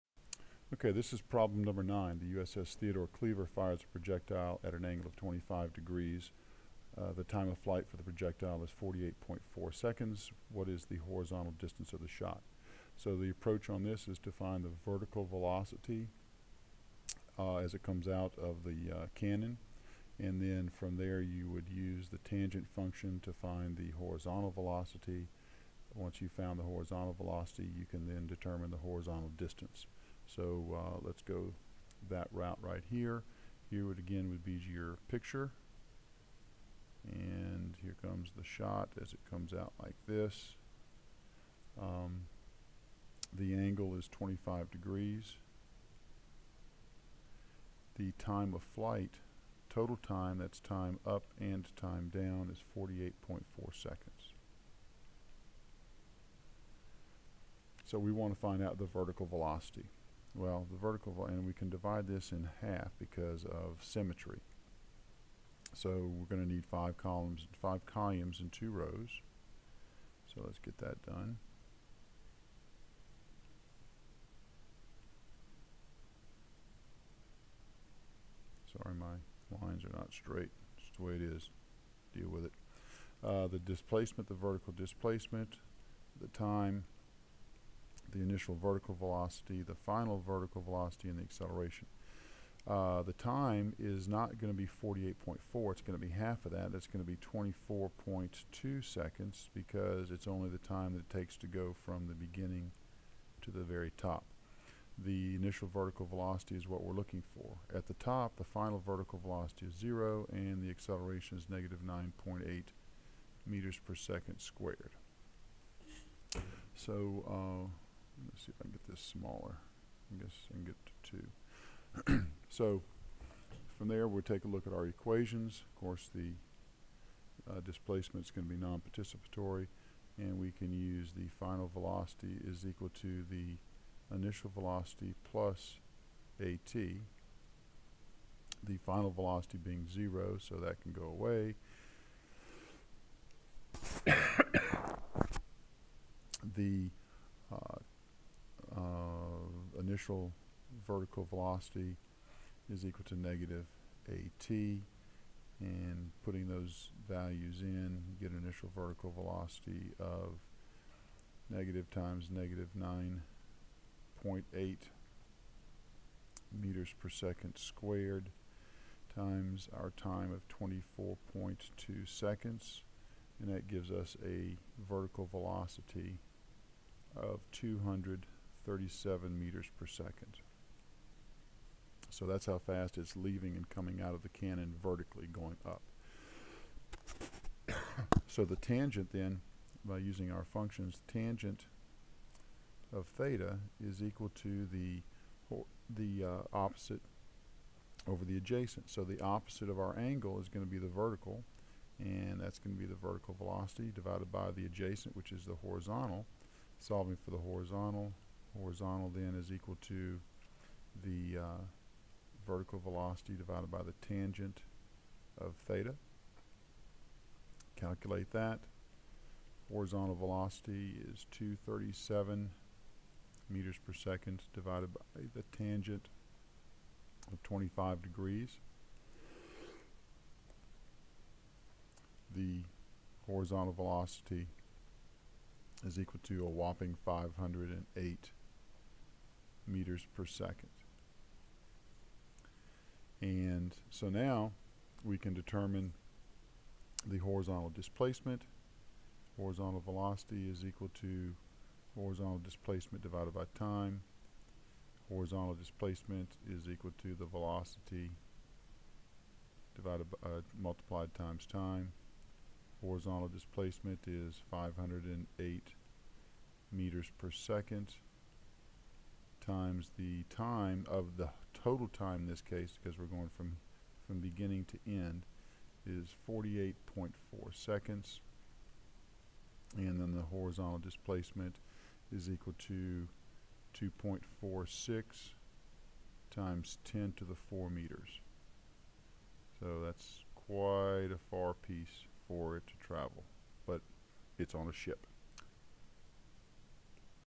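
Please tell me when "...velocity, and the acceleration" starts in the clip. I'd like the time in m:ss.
1:30.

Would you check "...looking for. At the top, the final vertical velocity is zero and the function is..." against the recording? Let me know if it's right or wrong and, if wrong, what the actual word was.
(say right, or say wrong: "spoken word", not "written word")
wrong: "acceleration", not "function".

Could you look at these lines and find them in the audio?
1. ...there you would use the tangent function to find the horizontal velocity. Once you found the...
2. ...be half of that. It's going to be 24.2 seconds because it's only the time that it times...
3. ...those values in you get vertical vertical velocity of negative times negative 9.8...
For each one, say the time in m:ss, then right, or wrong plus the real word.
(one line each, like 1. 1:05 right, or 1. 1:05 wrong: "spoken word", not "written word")
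1. 0:20 right
2. 1:36 wrong: "takes", not "times"
3. 2:36 wrong: "initial", not "vertical".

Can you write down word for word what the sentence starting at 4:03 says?
And so now we can determine the horizontal displacement.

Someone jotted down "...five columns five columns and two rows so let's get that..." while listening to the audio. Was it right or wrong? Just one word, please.
right.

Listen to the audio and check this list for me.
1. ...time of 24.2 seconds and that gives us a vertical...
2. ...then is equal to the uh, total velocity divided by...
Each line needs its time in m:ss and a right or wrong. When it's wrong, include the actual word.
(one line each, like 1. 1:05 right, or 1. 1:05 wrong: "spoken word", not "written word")
1. 2:49 right
2. 3:29 wrong: "vertical", not "total".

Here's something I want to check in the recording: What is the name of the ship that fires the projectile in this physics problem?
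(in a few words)
USS Theodore Cleaver.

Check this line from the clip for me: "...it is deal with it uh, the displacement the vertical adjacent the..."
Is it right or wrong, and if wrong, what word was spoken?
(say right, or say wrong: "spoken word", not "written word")
wrong: "displacement", not "adjacent".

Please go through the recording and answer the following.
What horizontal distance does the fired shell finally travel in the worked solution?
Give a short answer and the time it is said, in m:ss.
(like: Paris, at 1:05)
2.46 × 10^4 meters, at 4:43.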